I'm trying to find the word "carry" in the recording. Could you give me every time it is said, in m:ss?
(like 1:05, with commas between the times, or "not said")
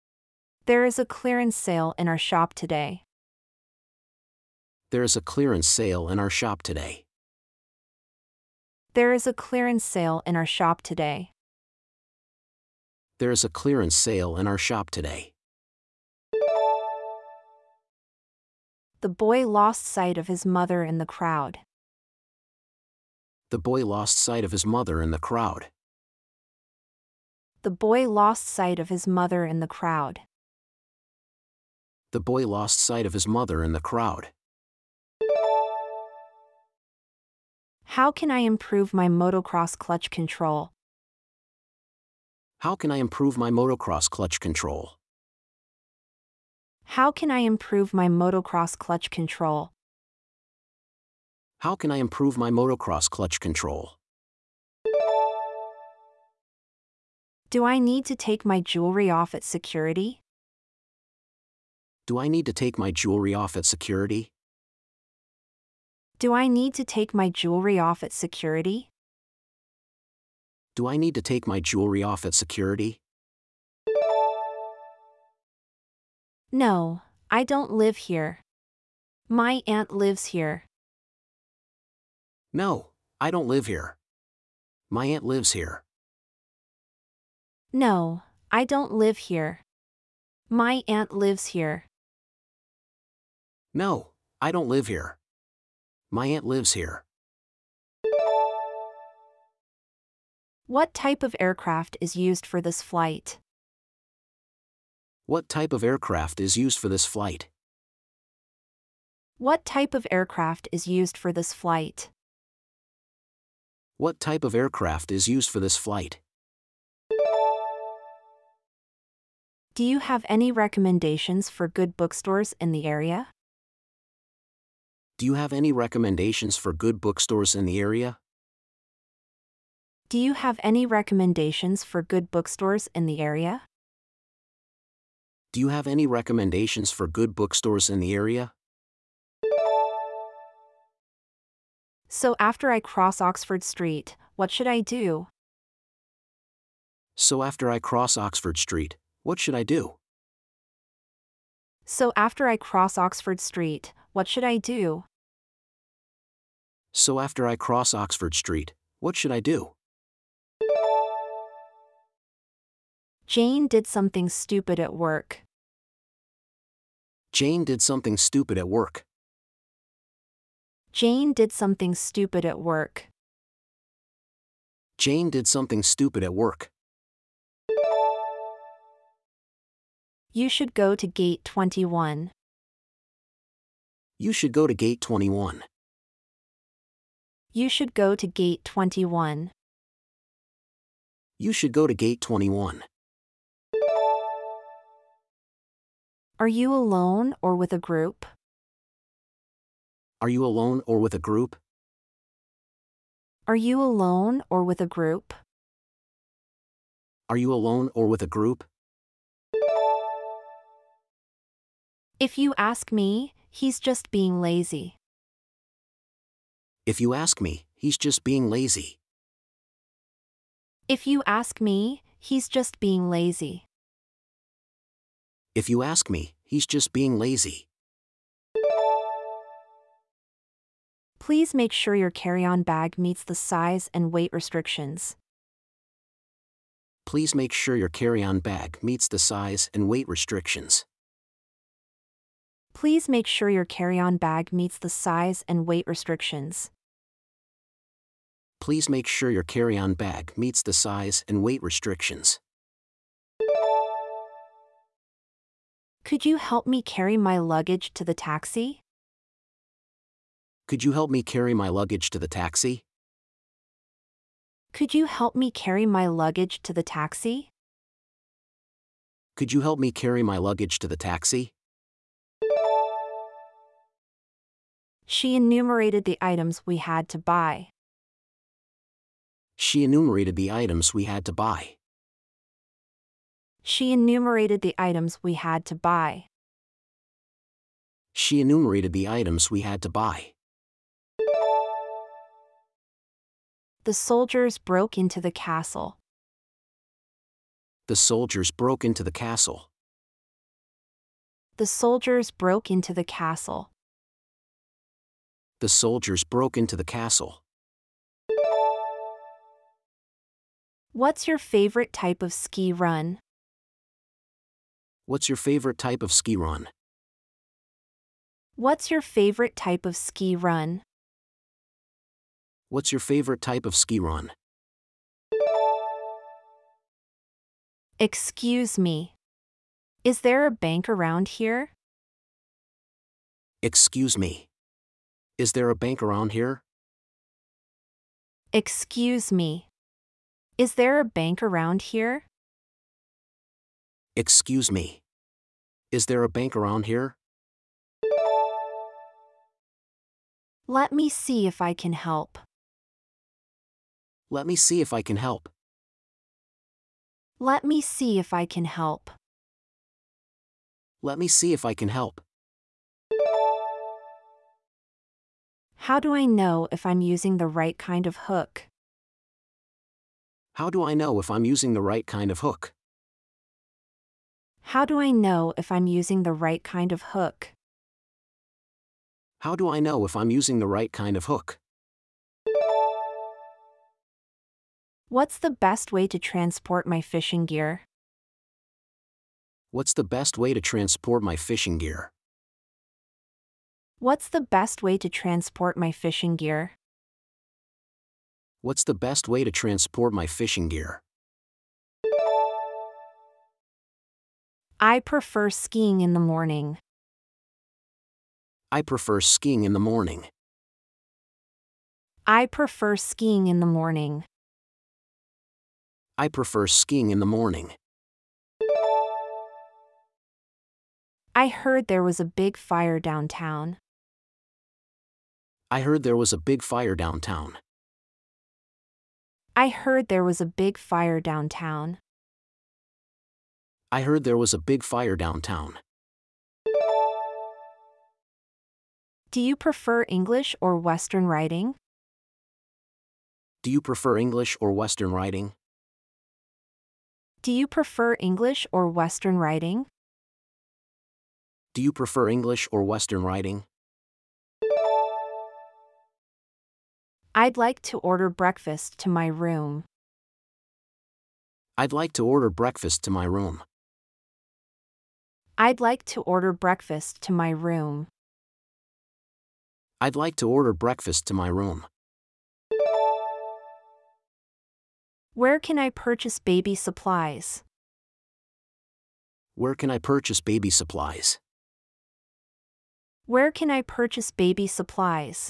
3:52, 3:57, 4:03, 4:09, 4:16, 4:21, 4:25, 4:29.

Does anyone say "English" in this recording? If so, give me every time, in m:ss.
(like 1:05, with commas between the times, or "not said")
7:20, 7:24, 7:28, 7:32.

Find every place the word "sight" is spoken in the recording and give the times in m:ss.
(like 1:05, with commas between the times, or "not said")
0:19, 0:24, 0:28, 0:32.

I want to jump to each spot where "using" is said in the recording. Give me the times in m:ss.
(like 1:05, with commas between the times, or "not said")
6:07, 6:11, 6:15, 6:20.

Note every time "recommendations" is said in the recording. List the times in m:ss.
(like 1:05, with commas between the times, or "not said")
2:00, 2:05, 2:10, 2:16.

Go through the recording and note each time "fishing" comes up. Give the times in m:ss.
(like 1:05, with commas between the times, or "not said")
6:27, 6:31, 6:35, 6:40.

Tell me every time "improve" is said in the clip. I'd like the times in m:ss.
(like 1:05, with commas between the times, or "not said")
0:38, 0:42, 0:47, 0:51.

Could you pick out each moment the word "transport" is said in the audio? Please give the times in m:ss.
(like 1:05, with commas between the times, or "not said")
6:26, 6:30, 6:35, 6:39.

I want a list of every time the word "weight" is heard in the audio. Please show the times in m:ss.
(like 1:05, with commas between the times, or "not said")
3:54, 3:59, 4:05, 4:11.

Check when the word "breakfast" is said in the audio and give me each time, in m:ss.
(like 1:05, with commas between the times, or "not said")
7:38, 7:42, 7:46, 7:50.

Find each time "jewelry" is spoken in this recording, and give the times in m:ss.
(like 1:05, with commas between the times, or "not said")
0:58, 1:02, 1:07, 1:11.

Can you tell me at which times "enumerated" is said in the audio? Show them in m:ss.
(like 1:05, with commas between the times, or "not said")
4:35, 4:39, 4:43, 4:48.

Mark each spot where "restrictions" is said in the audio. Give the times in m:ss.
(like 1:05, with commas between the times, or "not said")
3:54, 4:00, 4:05, 4:11.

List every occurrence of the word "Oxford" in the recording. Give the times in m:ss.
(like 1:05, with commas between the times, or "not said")
2:23, 2:28, 2:32, 2:37.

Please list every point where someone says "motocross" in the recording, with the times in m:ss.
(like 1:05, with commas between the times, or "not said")
0:39, 0:43, 0:48, 0:52.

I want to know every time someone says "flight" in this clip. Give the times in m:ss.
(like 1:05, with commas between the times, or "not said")
1:42, 1:47, 1:51, 1:55.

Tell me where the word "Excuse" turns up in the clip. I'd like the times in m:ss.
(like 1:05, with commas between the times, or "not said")
5:27, 5:33, 5:38, 5:44.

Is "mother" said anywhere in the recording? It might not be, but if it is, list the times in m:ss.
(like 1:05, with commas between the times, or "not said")
0:20, 0:24, 0:29, 0:33.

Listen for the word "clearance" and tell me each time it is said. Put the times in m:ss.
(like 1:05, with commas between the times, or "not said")
0:01, 0:05, 0:09, 0:13.